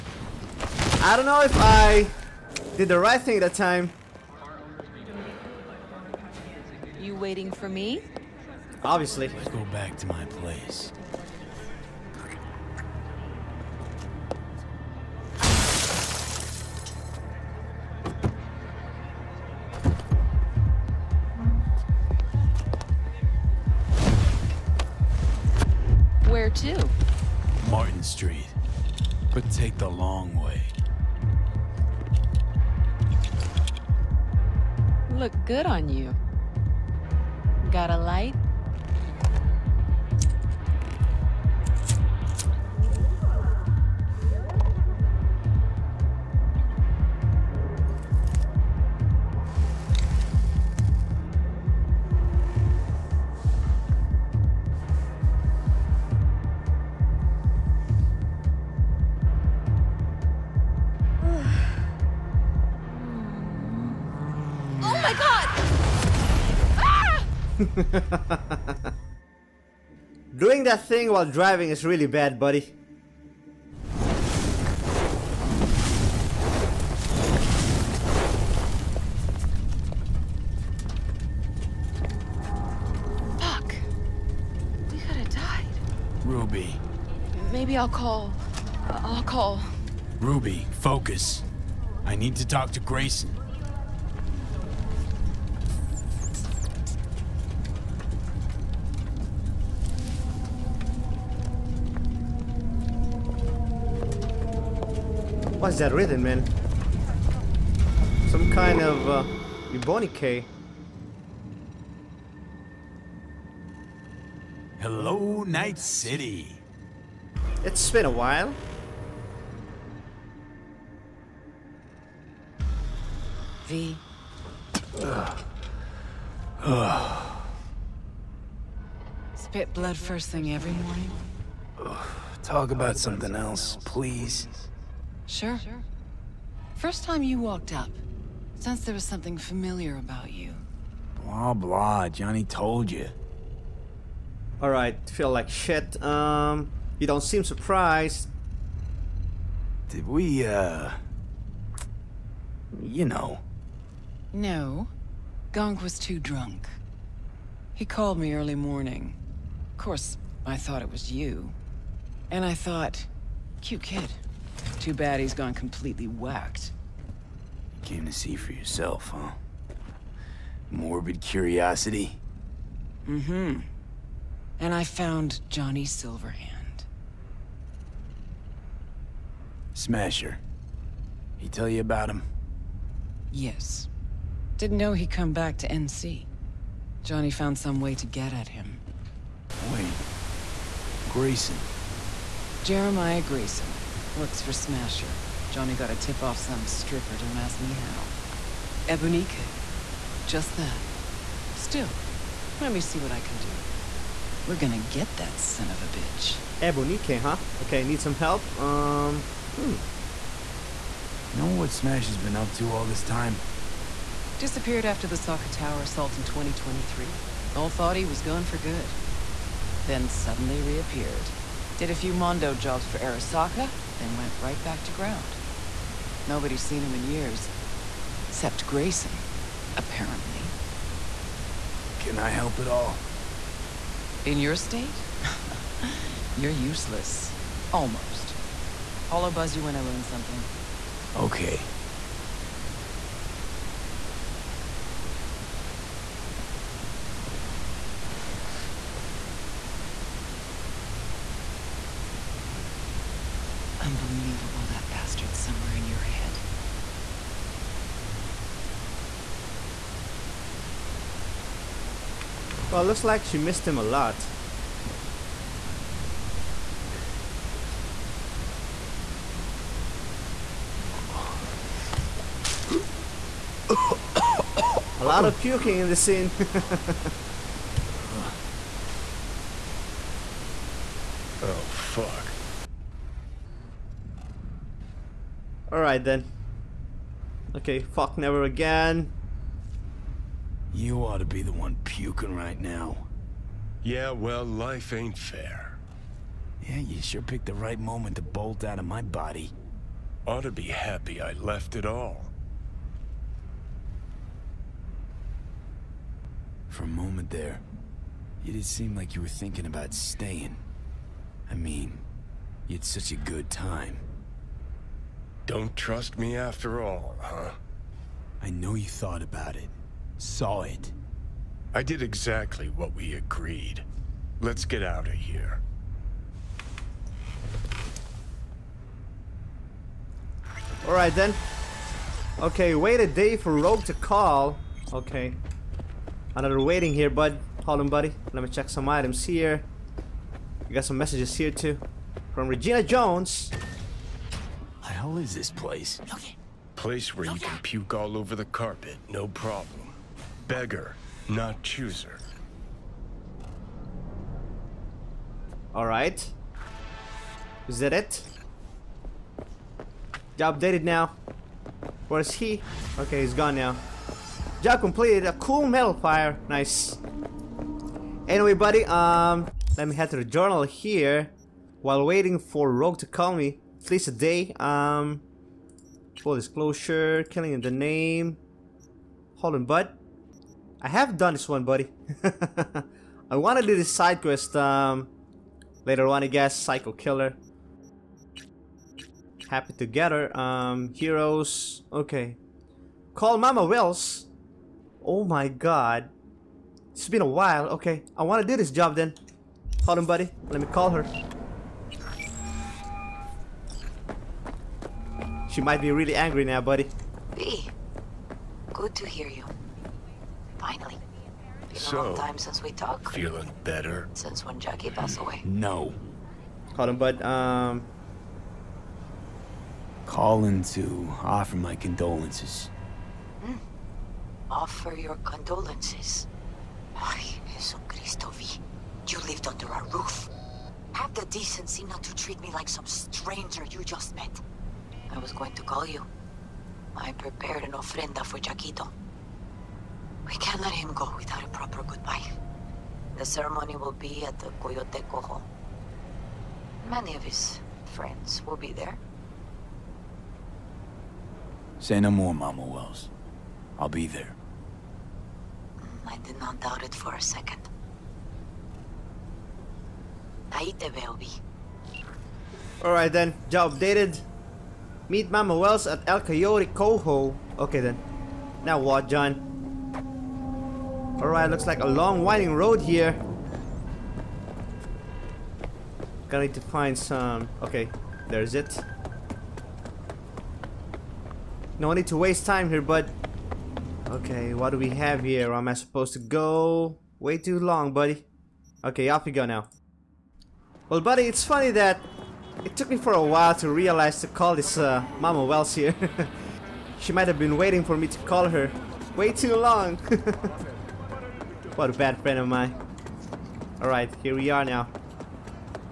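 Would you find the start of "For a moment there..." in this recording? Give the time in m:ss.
5:06.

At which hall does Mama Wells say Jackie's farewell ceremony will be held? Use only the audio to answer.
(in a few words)
Coyote Hall.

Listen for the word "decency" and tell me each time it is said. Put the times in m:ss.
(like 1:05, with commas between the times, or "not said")
7:11.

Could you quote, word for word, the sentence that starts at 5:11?
I mean, you had such a good time.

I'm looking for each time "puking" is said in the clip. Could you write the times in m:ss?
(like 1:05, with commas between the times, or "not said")
4:35, 4:51.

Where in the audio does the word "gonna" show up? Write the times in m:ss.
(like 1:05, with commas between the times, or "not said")
3:24, 7:56.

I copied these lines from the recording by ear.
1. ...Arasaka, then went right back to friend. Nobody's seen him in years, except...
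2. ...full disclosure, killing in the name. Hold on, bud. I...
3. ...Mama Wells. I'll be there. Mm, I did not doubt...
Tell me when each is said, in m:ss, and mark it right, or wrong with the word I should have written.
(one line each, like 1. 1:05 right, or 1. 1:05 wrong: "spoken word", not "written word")
1. 3:42 wrong: "ground", not "friend"
2. 6:16 right
3. 7:32 right.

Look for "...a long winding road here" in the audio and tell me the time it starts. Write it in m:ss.
7:51.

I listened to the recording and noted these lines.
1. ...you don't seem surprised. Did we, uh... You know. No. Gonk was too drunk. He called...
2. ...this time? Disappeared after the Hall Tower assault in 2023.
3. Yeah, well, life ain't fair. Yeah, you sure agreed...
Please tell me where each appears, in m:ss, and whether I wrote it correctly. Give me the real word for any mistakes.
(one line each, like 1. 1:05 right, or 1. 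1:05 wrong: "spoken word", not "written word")
1. 2:26 right
2. 3:32 wrong: "Arasaka", not "Hall"
3. 4:53 wrong: "picked", not "agreed".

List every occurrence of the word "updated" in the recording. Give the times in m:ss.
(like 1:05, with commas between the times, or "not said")
6:00, 7:43.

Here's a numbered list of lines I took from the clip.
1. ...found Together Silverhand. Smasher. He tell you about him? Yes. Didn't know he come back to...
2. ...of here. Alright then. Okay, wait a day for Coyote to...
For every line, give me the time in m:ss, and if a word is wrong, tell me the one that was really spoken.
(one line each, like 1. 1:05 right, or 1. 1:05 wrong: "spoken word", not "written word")
1. 2:54 wrong: "Johnny", not "Together"
2. 5:25 wrong: "Rogue", not "Coyote".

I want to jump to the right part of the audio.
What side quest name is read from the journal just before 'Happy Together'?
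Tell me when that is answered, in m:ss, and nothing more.
6:26.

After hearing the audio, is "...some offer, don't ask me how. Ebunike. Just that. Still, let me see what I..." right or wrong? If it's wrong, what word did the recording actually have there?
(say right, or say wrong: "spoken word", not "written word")
wrong: "stripper", not "offer".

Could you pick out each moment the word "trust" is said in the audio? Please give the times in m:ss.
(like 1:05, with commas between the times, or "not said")
5:15.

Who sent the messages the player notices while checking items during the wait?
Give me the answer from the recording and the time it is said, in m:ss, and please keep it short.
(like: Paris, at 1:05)
Regina Jones, at 5:42.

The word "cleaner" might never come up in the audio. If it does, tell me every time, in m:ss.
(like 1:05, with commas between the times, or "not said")
not said.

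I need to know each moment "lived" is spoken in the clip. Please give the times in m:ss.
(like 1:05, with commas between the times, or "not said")
7:09.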